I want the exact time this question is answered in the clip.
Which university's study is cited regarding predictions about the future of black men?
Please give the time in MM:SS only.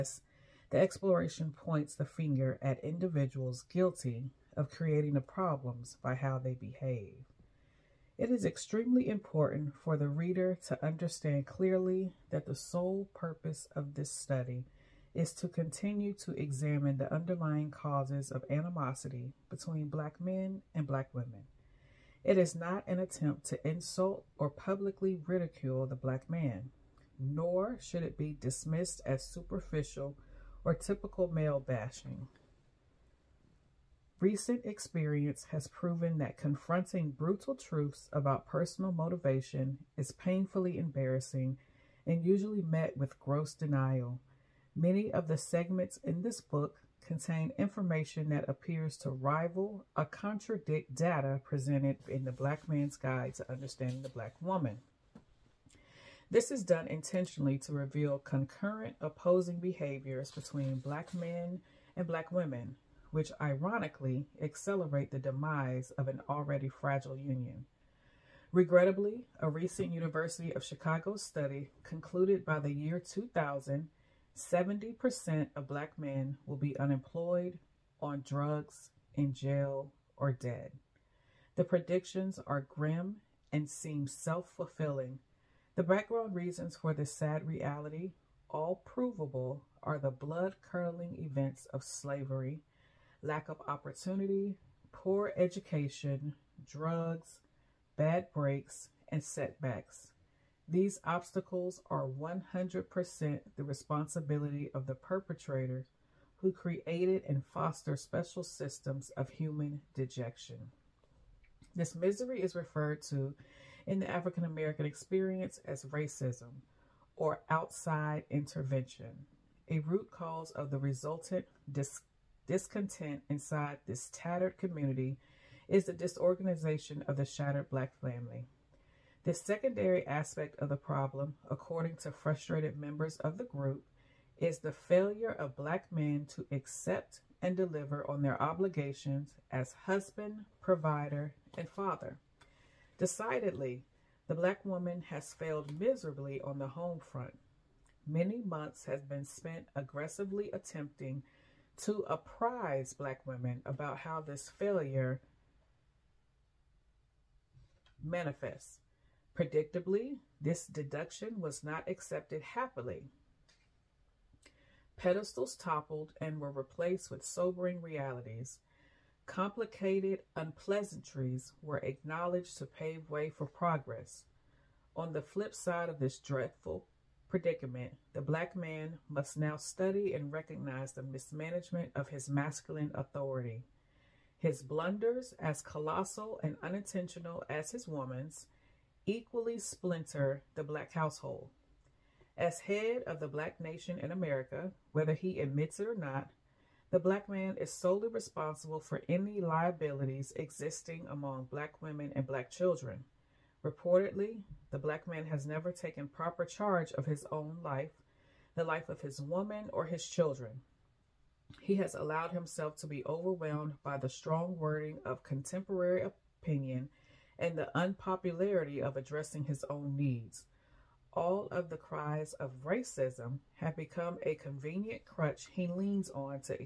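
01:09.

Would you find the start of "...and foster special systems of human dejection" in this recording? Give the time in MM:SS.
01:47.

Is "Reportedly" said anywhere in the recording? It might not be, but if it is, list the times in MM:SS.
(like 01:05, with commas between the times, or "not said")
03:23.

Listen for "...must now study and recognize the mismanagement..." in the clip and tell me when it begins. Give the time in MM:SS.
02:59.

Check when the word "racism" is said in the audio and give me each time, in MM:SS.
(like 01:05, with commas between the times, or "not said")
01:55, 03:42.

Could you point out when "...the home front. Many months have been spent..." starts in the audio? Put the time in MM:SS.
02:26.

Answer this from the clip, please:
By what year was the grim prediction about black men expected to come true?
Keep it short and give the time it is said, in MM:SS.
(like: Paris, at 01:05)
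2000, at 01:12.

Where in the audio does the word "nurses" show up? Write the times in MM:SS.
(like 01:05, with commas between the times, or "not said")
not said.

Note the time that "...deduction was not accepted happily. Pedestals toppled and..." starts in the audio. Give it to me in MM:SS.
02:40.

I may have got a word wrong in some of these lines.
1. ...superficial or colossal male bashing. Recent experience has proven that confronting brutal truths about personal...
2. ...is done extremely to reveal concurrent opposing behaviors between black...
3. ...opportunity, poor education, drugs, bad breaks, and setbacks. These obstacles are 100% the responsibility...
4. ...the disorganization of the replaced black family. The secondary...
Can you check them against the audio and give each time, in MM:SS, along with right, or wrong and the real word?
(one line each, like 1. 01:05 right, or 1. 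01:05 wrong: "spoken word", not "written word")
1. 00:29 wrong: "typical", not "colossal"
2. 00:56 wrong: "intentionally", not "extremely"
3. 01:33 right
4. 02:05 wrong: "shattered", not "replaced".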